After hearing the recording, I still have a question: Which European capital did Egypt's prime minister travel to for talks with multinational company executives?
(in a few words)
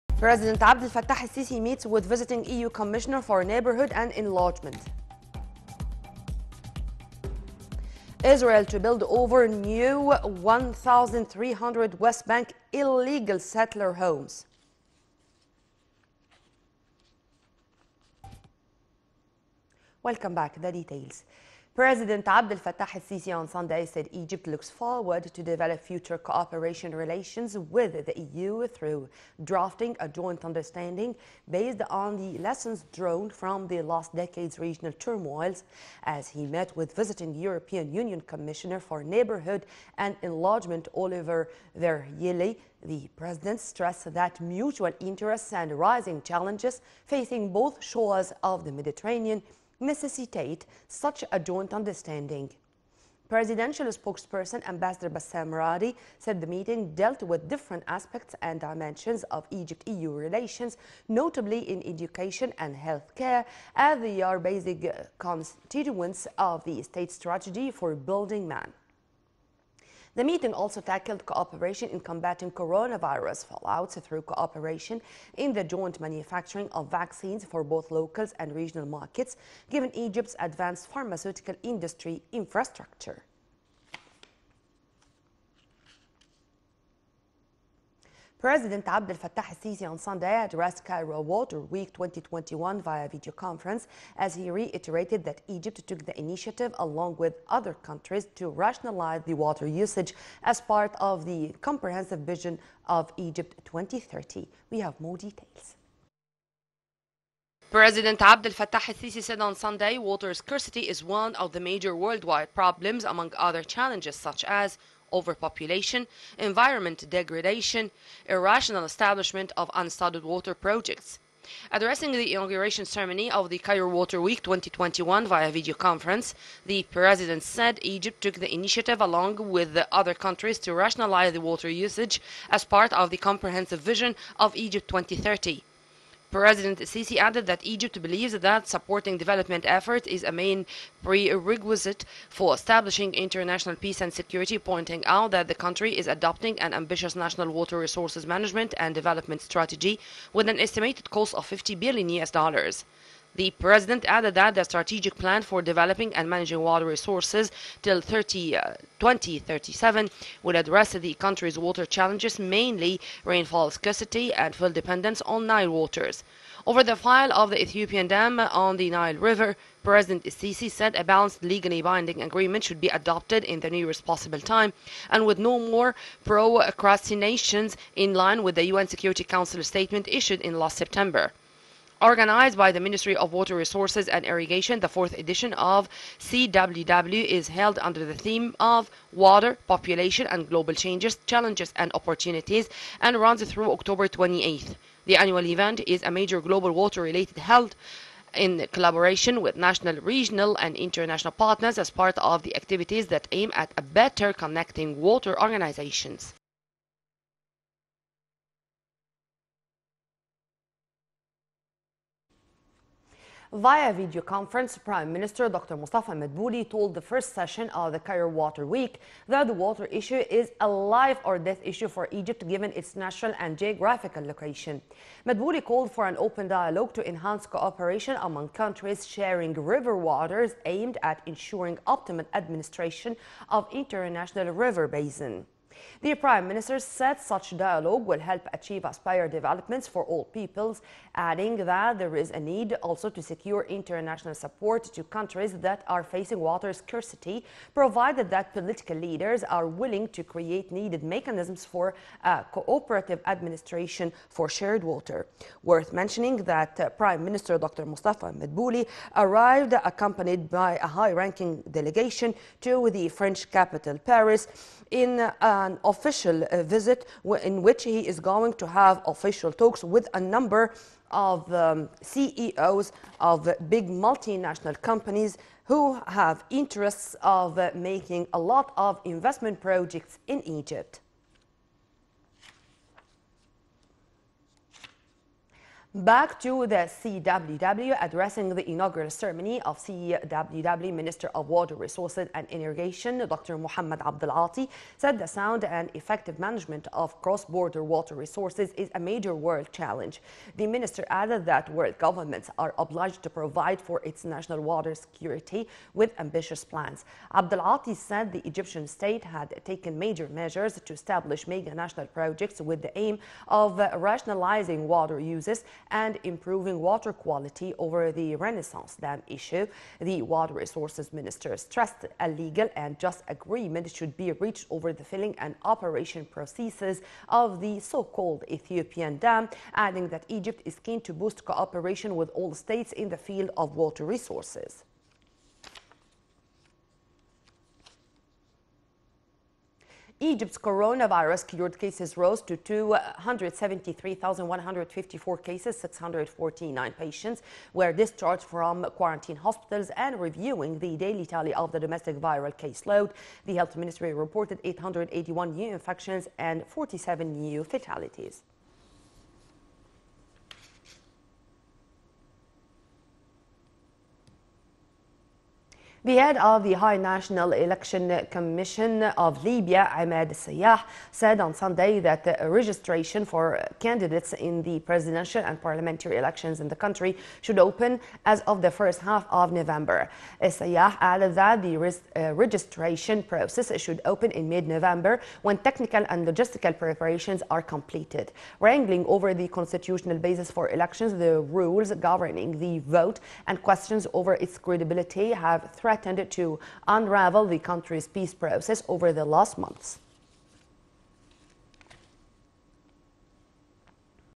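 Paris.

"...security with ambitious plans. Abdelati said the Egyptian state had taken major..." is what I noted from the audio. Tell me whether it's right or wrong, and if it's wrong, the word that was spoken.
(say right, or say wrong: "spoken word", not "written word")
right.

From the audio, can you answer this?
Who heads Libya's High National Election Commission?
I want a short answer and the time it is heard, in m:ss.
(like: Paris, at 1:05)
Ahmed Sayyah, at 6:09.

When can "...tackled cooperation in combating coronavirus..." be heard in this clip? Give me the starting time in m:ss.
1:10.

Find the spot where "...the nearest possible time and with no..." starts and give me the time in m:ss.
2:53.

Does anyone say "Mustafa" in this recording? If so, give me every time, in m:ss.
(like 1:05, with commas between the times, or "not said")
3:35, 4:17.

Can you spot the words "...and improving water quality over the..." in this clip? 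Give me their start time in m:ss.
5:15.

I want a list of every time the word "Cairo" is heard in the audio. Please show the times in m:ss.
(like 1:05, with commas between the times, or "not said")
1:30, 2:03, 3:37.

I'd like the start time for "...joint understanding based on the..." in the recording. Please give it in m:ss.
0:30.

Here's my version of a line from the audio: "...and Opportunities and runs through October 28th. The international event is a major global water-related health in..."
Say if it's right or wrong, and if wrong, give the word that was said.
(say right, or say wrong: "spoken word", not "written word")
wrong: "annual", not "international".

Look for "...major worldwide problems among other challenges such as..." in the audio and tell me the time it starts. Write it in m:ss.
1:51.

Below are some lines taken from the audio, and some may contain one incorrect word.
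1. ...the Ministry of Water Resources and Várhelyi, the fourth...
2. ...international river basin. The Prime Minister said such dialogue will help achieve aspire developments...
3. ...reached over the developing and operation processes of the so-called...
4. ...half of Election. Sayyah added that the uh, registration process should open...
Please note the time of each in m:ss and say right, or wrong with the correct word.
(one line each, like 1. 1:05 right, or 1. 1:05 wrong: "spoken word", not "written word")
1. 3:02 wrong: "Irrigation", not "Várhelyi"
2. 3:53 right
3. 5:24 wrong: "filling", not "developing"
4. 6:19 wrong: "November", not "Election".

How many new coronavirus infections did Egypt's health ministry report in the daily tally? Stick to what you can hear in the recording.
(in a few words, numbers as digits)
881.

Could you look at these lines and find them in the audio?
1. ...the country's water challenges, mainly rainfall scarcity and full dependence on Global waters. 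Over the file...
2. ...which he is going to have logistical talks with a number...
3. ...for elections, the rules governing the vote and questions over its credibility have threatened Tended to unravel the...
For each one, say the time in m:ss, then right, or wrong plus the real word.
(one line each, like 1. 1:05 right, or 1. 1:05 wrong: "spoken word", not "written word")
1. 2:40 wrong: "Nile", not "Global"
2. 4:27 wrong: "official", not "logistical"
3. 6:30 right.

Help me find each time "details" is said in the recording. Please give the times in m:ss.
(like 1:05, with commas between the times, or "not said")
0:20, 1:45.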